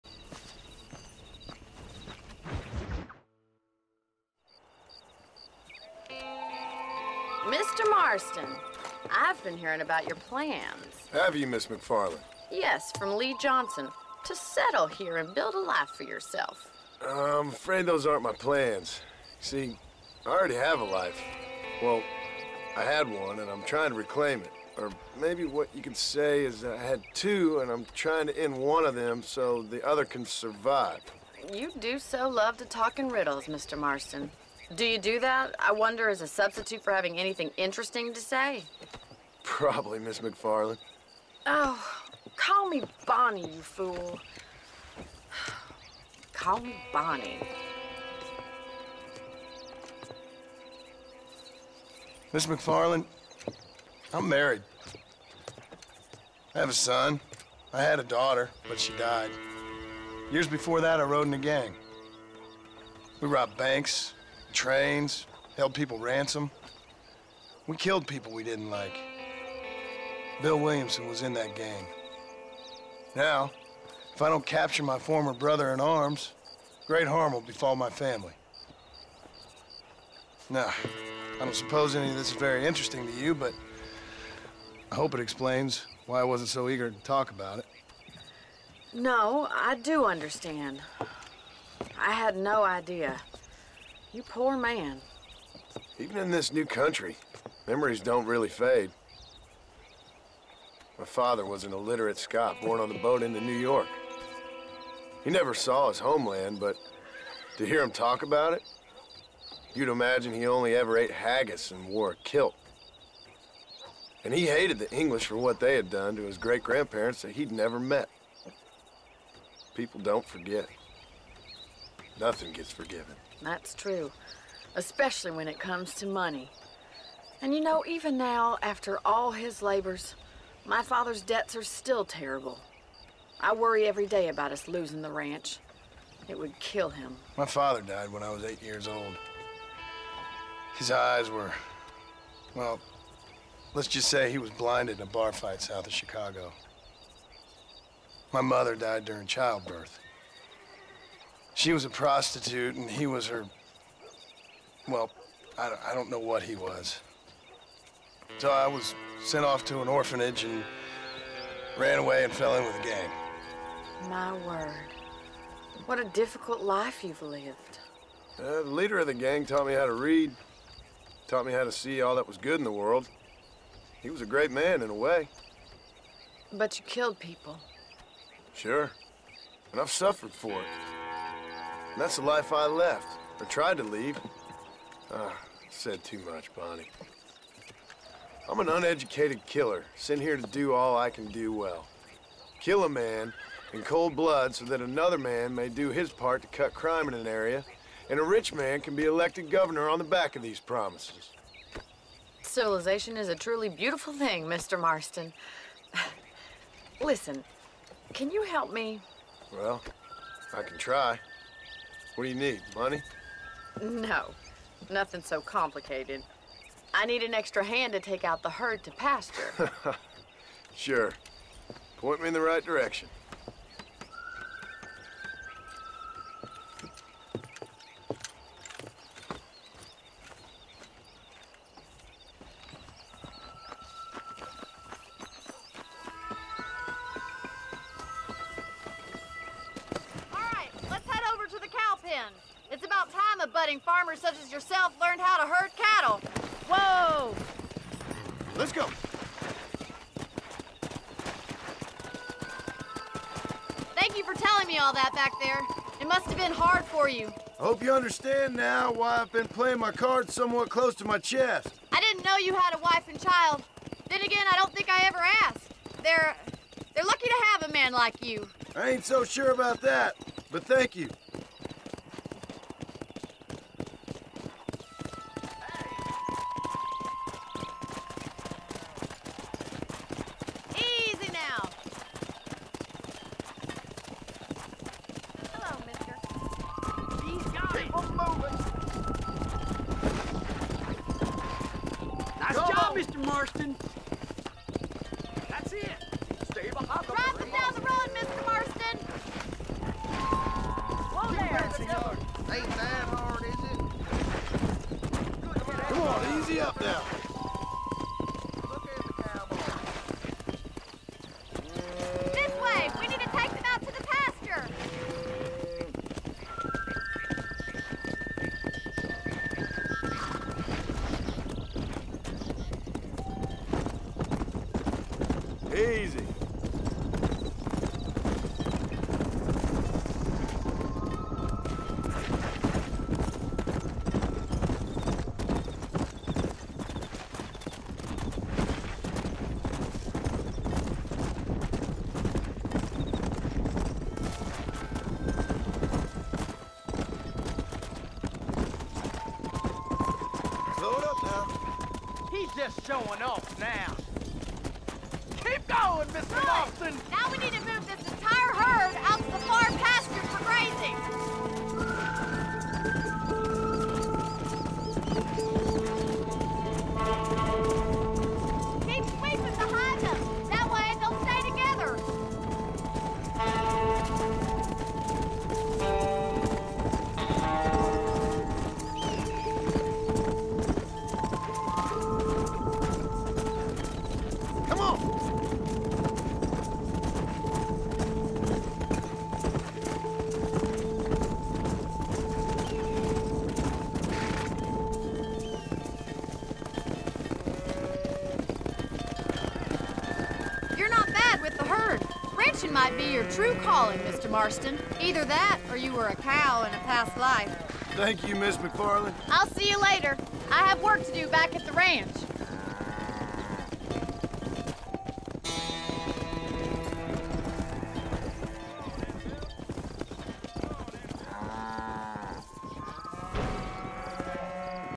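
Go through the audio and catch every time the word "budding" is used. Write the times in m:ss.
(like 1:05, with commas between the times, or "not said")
4:03.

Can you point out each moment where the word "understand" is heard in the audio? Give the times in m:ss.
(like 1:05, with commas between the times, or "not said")
1:30, 4:17.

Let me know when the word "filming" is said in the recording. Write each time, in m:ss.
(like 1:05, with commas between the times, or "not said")
not said.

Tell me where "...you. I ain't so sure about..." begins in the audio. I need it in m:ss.
4:28.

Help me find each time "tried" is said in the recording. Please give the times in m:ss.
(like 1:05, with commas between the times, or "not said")
3:03.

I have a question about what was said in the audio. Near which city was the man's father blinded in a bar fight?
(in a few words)
Chicago.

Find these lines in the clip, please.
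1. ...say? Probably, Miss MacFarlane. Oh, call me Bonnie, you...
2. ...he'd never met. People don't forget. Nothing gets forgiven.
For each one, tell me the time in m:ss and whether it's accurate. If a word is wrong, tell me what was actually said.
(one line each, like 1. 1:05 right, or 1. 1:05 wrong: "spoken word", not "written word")
1. 0:38 right
2. 1:57 right.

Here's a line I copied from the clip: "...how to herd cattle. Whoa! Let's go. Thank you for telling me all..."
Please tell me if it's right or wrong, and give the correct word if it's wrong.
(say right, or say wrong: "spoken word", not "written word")
right.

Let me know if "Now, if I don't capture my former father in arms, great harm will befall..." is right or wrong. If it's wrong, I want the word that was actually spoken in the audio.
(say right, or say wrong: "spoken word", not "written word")
wrong: "brother", not "father".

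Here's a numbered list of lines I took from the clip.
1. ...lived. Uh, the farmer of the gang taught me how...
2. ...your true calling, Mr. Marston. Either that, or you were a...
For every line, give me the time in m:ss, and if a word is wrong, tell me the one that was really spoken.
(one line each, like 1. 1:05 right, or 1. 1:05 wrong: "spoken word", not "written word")
1. 2:47 wrong: "leader", not "farmer"
2. 6:43 right.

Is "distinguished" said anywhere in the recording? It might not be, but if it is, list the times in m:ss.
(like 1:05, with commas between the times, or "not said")
not said.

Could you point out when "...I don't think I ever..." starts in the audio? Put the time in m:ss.
4:24.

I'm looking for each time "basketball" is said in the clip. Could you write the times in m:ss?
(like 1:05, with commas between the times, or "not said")
not said.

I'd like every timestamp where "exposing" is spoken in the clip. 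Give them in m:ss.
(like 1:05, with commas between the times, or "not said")
not said.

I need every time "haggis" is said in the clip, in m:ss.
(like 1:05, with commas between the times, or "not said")
1:51.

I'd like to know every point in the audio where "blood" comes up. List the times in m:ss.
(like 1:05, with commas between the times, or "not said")
3:14.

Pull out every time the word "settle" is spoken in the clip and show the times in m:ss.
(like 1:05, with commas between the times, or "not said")
0:14.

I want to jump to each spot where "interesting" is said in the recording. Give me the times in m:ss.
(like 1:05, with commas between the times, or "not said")
0:37, 1:22.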